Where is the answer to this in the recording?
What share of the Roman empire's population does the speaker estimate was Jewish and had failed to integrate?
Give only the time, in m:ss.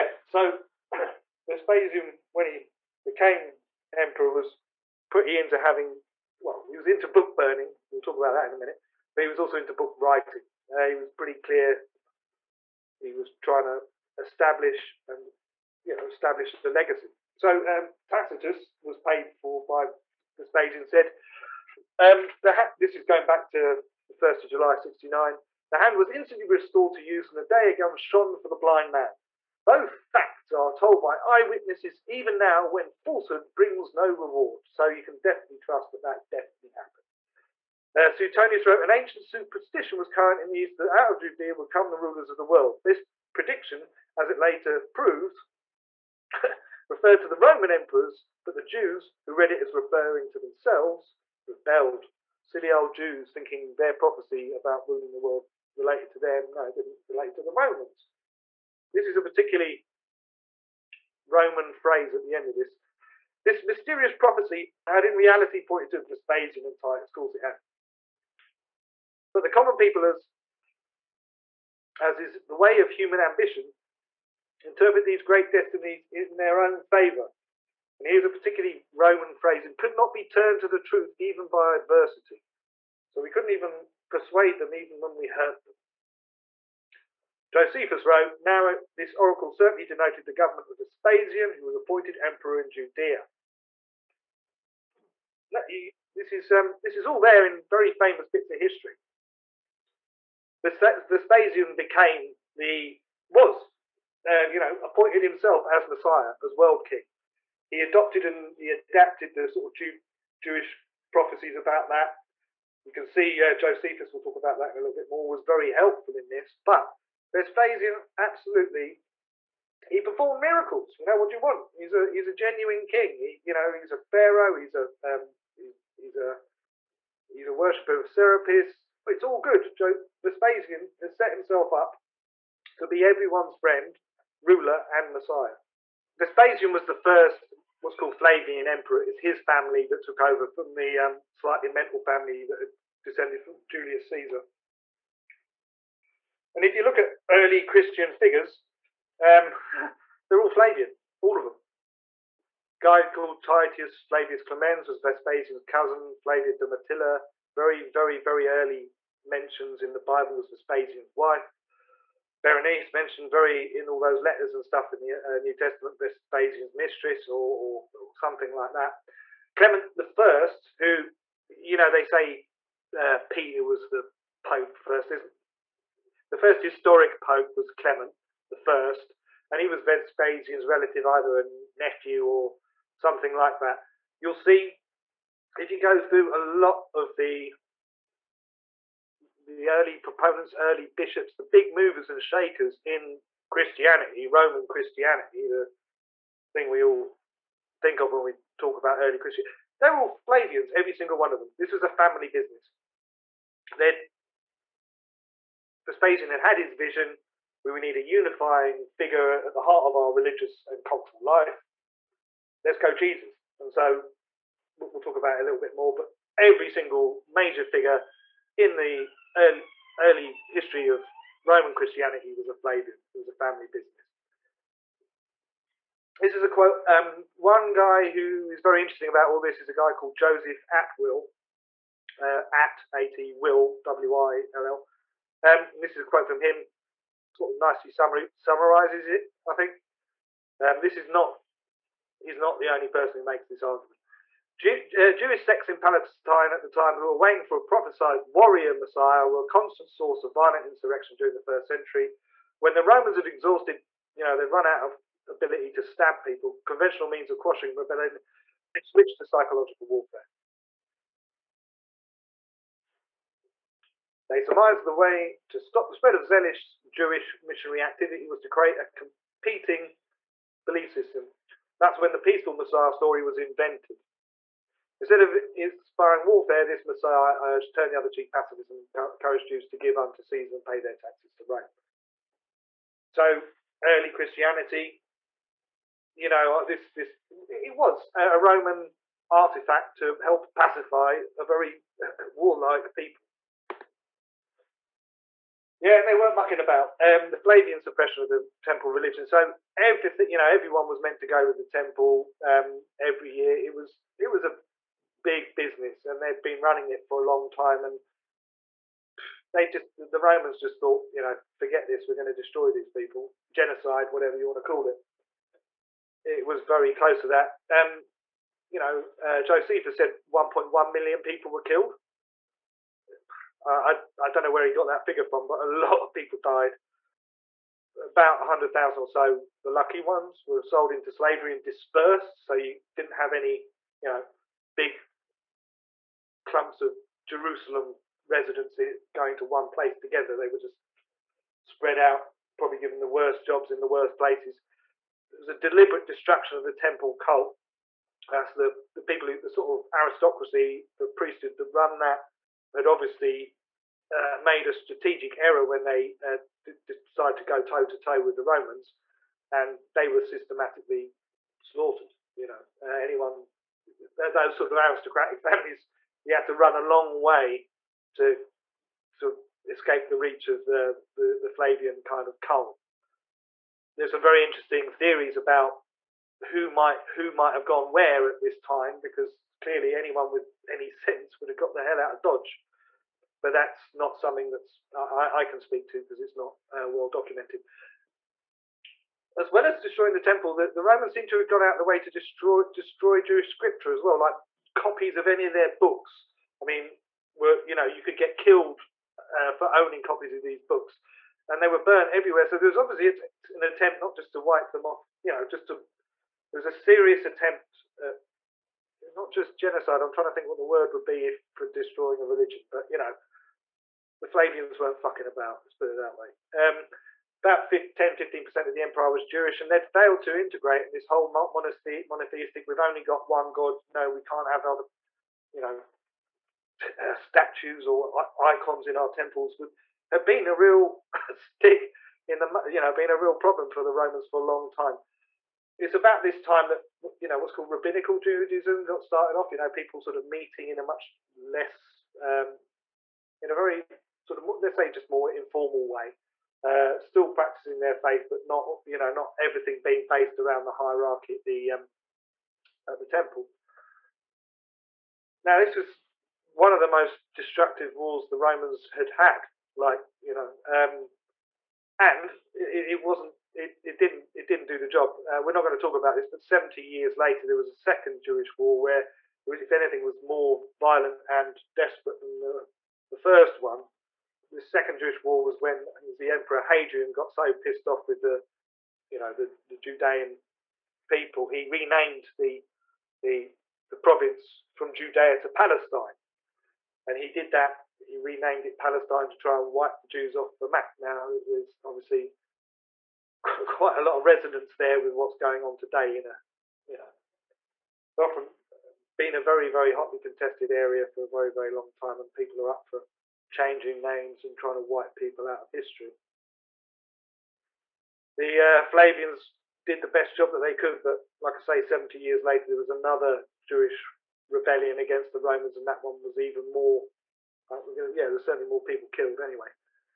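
6:57.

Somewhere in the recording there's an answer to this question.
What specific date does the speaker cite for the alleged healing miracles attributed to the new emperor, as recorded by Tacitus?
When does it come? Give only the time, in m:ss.
0:24.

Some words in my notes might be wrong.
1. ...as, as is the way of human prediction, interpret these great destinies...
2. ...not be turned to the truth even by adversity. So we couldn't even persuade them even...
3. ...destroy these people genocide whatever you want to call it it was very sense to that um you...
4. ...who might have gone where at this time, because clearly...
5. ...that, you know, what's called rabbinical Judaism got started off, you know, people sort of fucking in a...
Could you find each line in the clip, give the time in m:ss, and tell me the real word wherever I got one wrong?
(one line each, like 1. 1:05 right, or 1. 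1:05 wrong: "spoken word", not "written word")
1. 1:10 wrong: "ambition", not "prediction"
2. 1:19 right
3. 5:12 wrong: "close", not "sense"
4. 6:17 right
5. 7:16 wrong: "meeting", not "fucking".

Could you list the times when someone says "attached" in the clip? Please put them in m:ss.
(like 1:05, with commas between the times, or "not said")
not said.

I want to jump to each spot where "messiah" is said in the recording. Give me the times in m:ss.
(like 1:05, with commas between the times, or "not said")
1:45, 2:15, 4:08, 4:32, 4:36.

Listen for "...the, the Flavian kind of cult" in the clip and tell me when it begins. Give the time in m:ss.
6:11.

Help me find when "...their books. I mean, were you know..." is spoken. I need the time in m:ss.
6:35.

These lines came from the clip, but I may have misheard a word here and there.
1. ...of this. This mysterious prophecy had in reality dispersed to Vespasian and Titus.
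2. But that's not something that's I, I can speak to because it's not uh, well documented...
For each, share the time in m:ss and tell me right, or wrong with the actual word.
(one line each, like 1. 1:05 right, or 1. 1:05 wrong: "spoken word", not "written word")
1. 1:02 wrong: "pointed", not "dispersed"
2. 6:23 right.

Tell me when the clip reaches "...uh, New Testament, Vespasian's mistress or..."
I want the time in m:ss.
2:45.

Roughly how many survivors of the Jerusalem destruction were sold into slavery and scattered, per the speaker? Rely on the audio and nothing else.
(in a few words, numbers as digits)
About 100,000.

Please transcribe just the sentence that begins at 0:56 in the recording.
No, it didn't relate to the Romans.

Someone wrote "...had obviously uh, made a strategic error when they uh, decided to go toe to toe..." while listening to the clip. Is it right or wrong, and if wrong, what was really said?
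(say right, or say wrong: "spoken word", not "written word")
right.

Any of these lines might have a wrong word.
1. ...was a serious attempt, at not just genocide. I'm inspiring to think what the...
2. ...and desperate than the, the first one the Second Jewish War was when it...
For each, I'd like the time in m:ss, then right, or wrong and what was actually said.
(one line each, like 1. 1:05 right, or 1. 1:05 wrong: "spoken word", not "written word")
1. 6:46 wrong: "trying", not "inspiring"
2. 7:51 right.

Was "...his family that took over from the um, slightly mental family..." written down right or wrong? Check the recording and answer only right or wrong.
right.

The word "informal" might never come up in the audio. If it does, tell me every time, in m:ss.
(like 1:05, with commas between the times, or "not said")
7:25.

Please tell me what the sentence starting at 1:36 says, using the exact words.
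This is, um, this is all there in very famous bits of history.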